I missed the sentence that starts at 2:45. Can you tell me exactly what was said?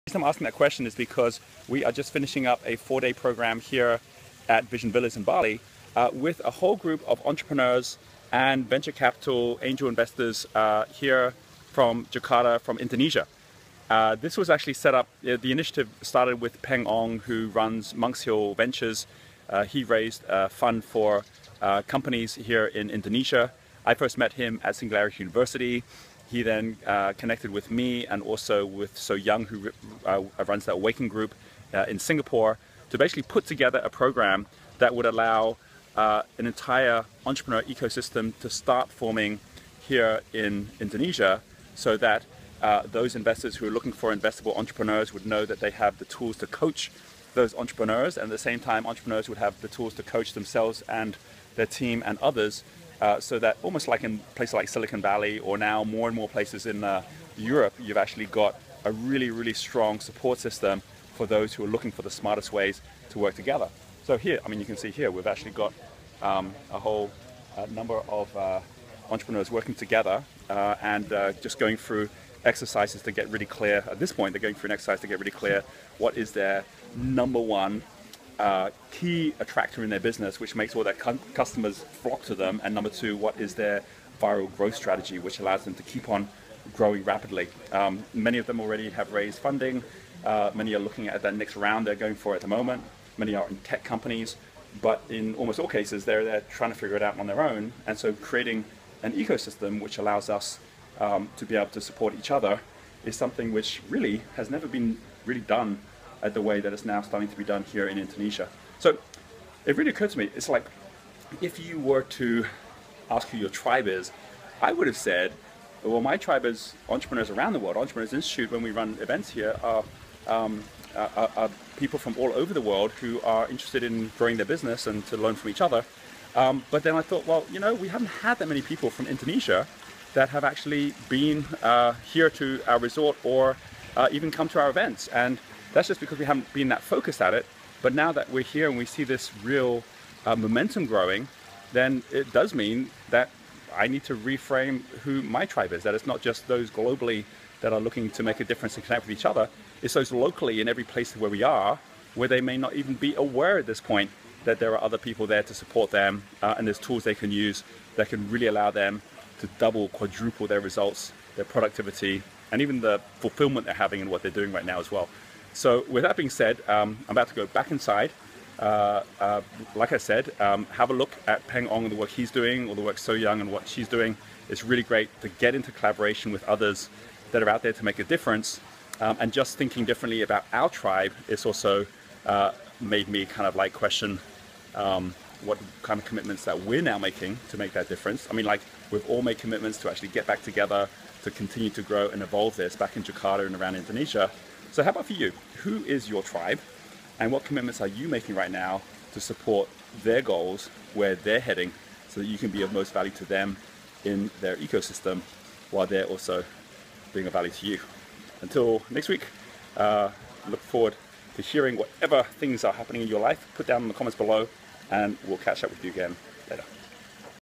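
So with that being said, um, I'm about to go back inside.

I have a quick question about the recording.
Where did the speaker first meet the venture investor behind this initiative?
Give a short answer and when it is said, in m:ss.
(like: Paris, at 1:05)
Singularity University, at 0:24.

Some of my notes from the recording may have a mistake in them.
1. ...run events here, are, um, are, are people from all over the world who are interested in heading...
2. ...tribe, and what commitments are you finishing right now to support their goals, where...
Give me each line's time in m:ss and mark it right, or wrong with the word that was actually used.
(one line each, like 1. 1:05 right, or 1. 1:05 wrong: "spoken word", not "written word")
1. 1:58 wrong: "growing", not "heading"
2. 3:16 wrong: "making", not "finishing".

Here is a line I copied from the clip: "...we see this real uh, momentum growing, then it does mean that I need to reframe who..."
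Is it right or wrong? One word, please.
right.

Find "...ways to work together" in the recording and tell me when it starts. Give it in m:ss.
1:02.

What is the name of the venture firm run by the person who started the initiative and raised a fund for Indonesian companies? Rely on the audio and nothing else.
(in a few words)
Monks Hill Ventures.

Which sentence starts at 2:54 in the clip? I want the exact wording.
It's really great to get into collaboration with others that are out there to make a difference.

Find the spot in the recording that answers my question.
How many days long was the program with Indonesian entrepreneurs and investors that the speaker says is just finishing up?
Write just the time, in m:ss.
0:02.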